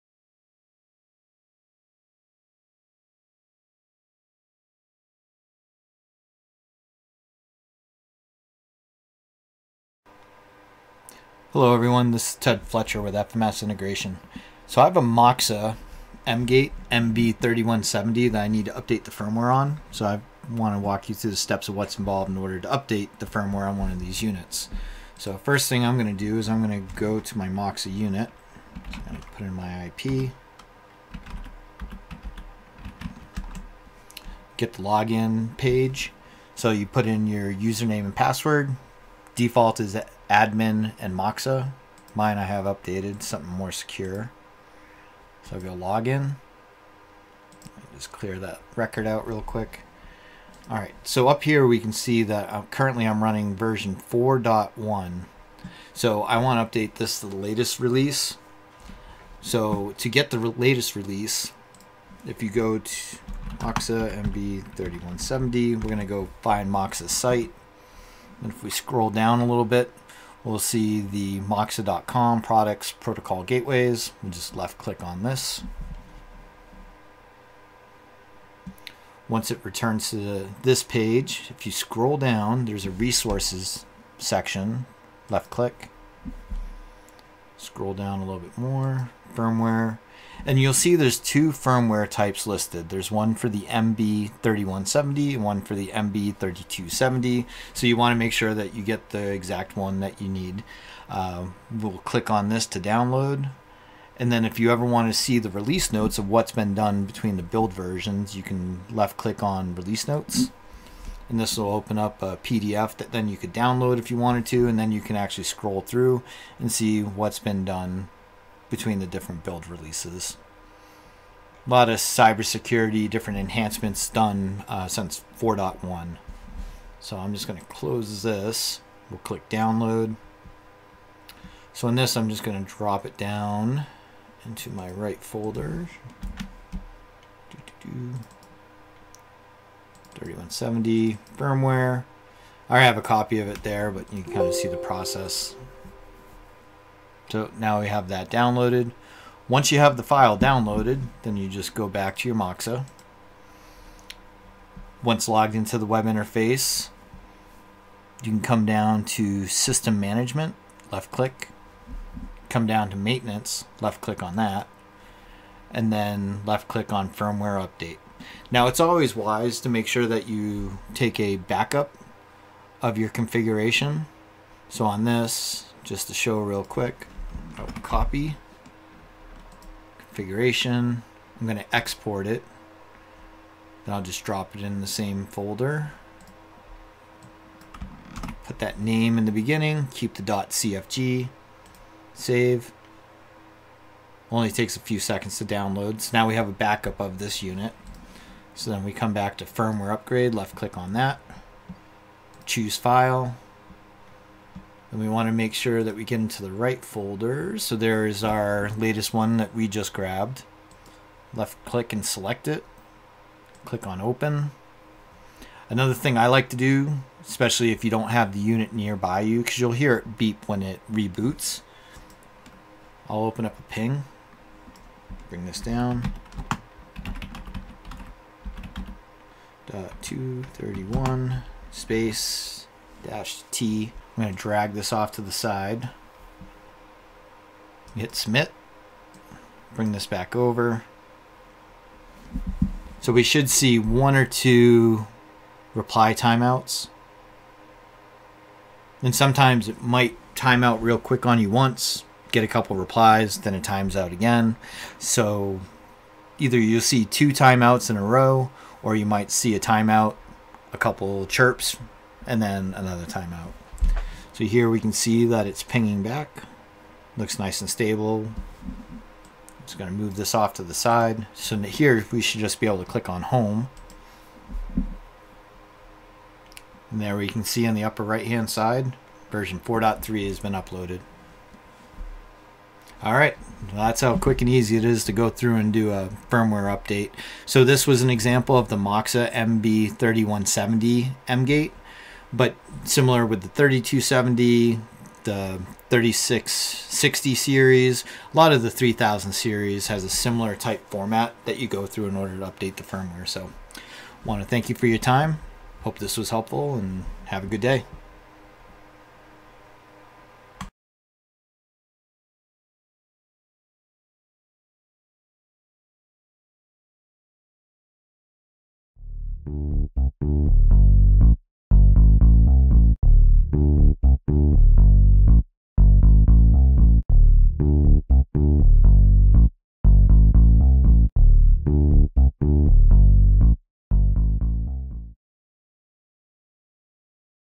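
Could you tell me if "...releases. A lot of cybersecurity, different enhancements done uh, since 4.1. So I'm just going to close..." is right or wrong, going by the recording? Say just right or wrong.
right.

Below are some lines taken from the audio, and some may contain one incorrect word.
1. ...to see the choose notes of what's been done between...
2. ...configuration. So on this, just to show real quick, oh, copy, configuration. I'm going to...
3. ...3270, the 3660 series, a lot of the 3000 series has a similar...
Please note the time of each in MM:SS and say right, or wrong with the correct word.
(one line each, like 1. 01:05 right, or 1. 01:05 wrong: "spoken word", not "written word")
1. 01:45 wrong: "release", not "choose"
2. 02:53 right
3. 04:53 right.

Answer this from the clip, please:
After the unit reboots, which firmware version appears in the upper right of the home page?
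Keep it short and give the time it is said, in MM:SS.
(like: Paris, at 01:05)
4.3, at 04:39.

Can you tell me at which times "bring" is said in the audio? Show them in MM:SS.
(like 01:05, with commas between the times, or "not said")
03:45, 03:59.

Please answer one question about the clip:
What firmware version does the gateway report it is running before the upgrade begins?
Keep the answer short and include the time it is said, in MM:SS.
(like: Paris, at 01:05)
4.1, at 00:53.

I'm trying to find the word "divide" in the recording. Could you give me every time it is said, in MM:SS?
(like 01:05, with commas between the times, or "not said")
not said.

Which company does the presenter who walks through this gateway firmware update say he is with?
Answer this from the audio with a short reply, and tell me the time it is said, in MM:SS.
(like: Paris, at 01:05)
FMS Integration, at 00:13.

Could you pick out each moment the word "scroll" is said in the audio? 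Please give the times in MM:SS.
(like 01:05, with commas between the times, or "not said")
01:08, 01:21, 01:27, 01:55.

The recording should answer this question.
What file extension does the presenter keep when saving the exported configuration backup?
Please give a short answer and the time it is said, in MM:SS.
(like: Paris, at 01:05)
.cfg, at 03:10.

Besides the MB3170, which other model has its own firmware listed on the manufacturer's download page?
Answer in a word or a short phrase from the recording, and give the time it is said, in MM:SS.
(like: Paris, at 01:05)
MB3270, at 01:35.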